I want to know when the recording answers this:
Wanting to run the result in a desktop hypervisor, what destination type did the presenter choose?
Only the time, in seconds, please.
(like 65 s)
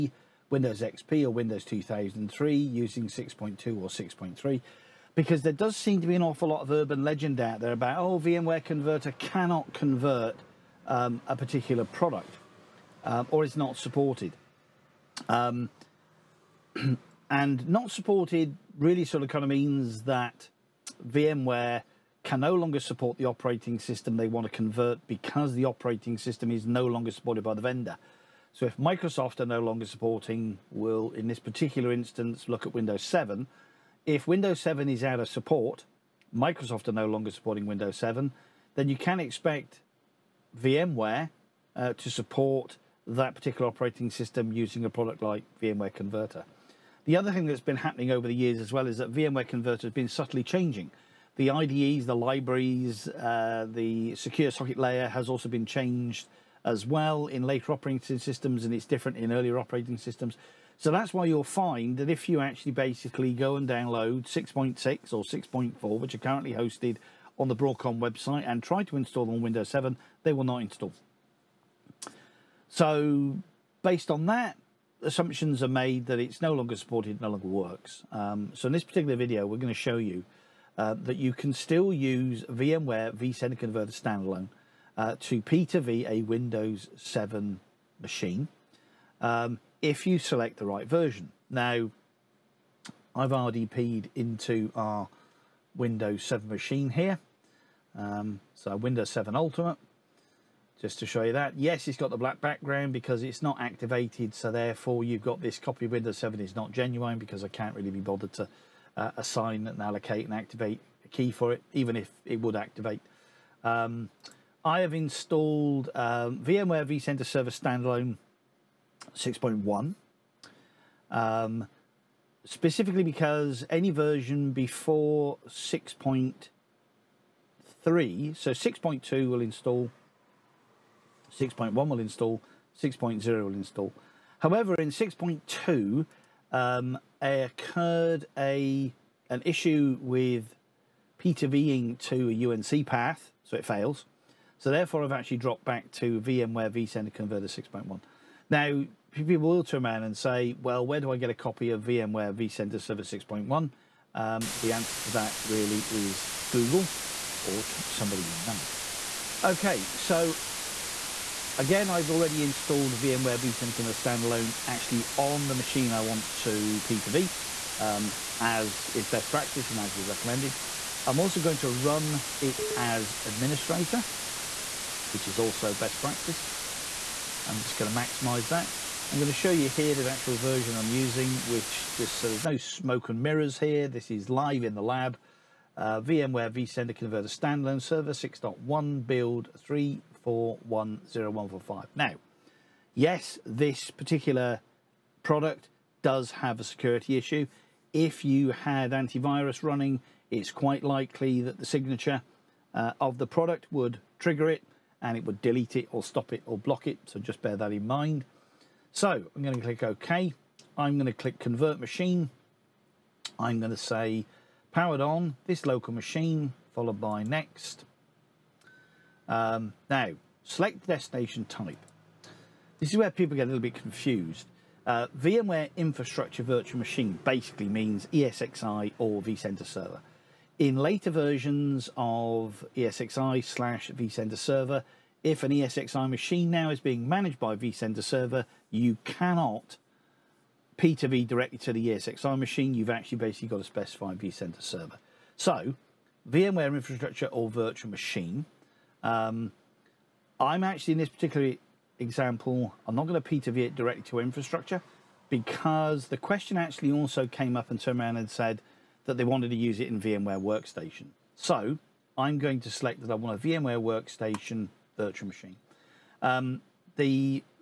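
263 s.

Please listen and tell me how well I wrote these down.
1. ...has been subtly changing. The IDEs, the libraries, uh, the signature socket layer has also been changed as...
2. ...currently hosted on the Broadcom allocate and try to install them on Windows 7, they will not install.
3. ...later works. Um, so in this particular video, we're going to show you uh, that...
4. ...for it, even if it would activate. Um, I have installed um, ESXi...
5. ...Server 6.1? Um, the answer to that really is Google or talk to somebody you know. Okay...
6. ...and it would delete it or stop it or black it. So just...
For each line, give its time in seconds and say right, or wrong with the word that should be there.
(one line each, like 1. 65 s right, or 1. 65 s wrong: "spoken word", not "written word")
1. 49 s wrong: "secure", not "signature"
2. 66 s wrong: "website", not "allocate"
3. 77 s wrong: "longer", not "later"
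4. 111 s wrong: "VMware", not "ESXi"
5. 152 s right
6. 205 s wrong: "block", not "black".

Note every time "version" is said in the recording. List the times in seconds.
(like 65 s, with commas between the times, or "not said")
90 s, 123 s, 180 s, 231 s.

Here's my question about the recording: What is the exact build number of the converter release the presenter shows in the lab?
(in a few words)
3410145.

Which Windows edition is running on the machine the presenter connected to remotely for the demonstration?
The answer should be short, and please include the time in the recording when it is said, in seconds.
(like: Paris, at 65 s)
Windows 7 Ultimate, at 98 s.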